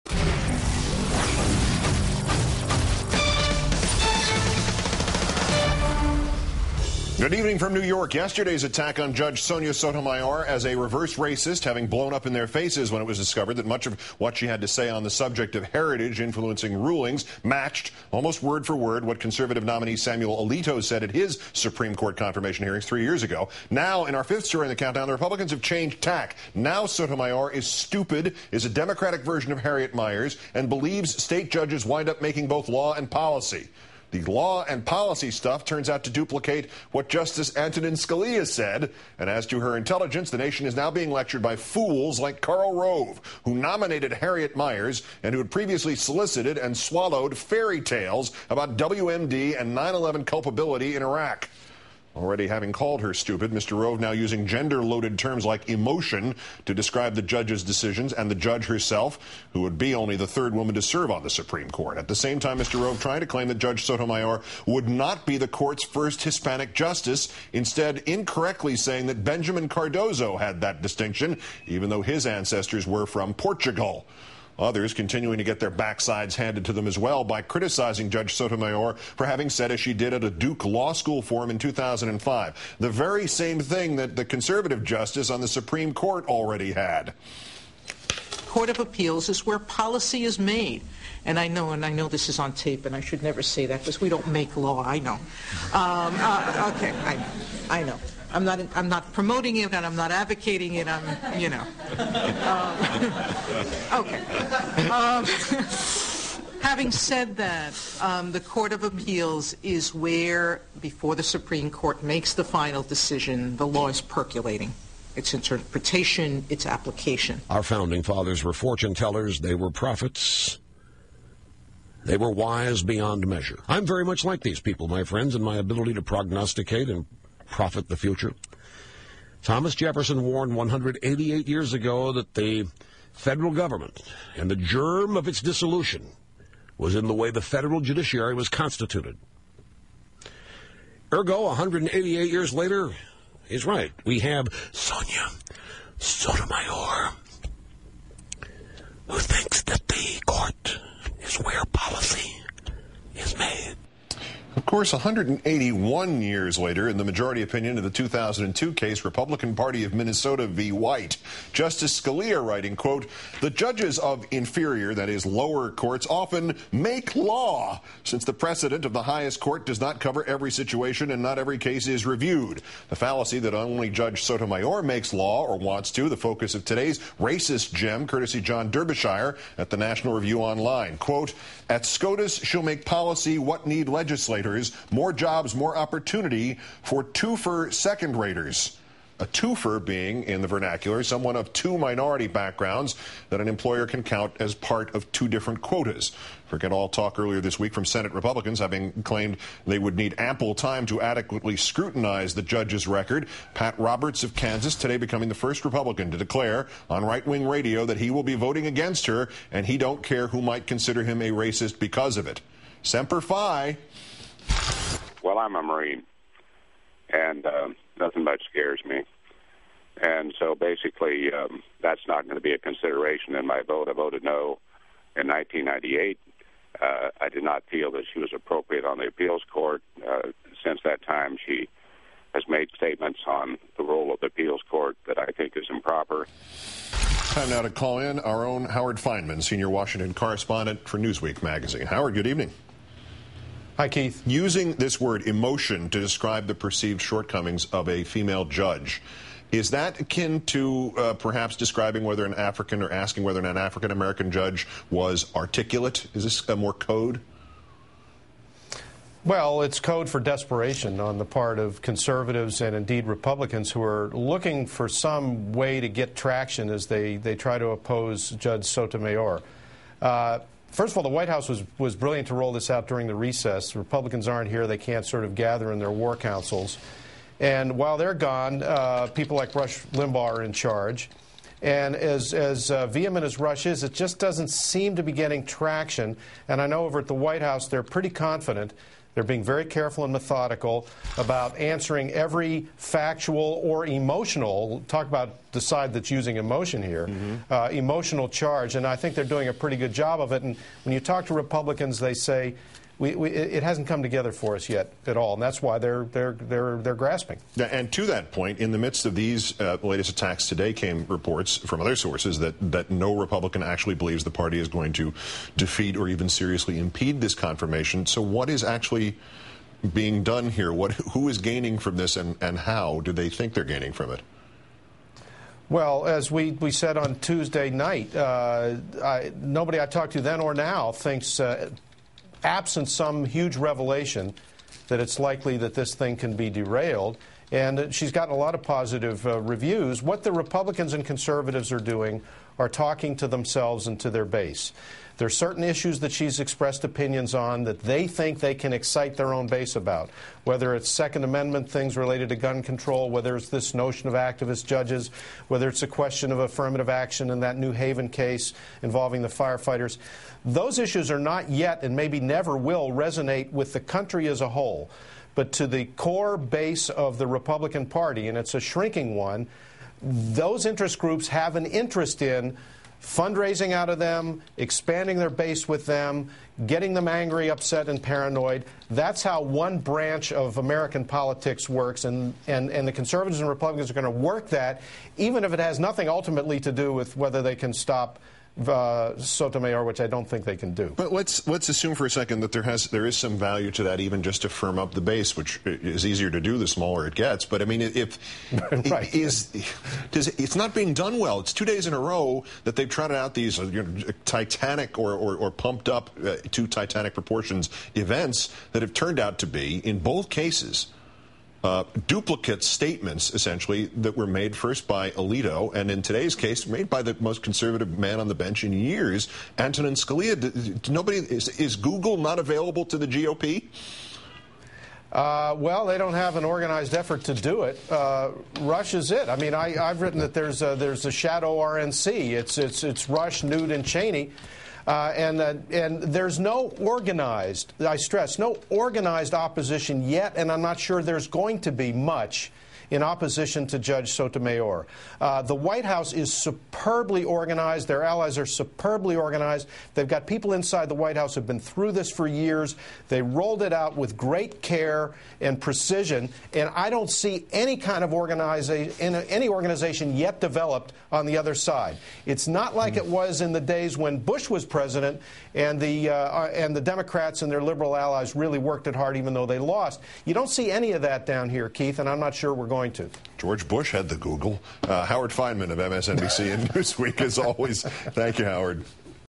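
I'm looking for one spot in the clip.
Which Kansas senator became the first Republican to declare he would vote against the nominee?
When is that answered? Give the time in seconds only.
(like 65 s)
203 s.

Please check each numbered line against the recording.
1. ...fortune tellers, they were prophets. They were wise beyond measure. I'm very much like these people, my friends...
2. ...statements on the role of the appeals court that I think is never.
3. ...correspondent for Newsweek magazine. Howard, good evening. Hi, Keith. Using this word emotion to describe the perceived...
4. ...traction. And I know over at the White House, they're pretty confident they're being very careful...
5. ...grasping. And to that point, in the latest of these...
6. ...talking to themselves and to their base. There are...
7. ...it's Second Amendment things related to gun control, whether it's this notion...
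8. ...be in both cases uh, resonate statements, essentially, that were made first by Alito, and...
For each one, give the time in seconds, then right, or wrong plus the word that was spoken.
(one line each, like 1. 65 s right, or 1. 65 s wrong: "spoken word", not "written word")
1. 118 s right
2. 232 s wrong: "improper", not "never"
3. 240 s right
4. 285 s right
5. 306 s wrong: "midst", not "latest"
6. 342 s right
7. 350 s right
8. 409 s wrong: "duplicate", not "resonate".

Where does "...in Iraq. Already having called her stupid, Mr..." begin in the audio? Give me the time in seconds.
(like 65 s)
50 s.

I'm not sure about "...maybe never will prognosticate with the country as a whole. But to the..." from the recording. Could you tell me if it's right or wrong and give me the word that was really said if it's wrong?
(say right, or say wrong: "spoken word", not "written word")
wrong: "resonate", not "prognosticate".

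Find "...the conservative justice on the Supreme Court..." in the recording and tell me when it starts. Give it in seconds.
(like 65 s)
84 s.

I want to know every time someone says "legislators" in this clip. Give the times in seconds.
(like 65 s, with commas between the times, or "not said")
183 s.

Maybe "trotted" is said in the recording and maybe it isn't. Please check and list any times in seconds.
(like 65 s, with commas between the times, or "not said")
402 s.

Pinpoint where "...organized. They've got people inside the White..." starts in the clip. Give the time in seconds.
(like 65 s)
449 s.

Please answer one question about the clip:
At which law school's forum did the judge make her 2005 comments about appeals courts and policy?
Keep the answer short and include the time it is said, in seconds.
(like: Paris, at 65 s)
Duke Law School, at 80 s.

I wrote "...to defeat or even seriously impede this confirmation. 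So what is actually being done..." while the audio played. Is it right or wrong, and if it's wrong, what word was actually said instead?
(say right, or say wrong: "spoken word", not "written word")
right.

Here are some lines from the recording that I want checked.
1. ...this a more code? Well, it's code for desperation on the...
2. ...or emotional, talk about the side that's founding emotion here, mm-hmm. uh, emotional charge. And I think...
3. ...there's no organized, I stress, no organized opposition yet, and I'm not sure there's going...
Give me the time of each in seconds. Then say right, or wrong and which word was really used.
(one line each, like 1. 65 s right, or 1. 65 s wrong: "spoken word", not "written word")
1. 256 s right
2. 293 s wrong: "using", not "founding"
3. 436 s right.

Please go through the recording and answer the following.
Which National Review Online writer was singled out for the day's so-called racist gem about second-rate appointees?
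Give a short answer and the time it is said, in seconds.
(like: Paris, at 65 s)
John Derbyshire, at 178 s.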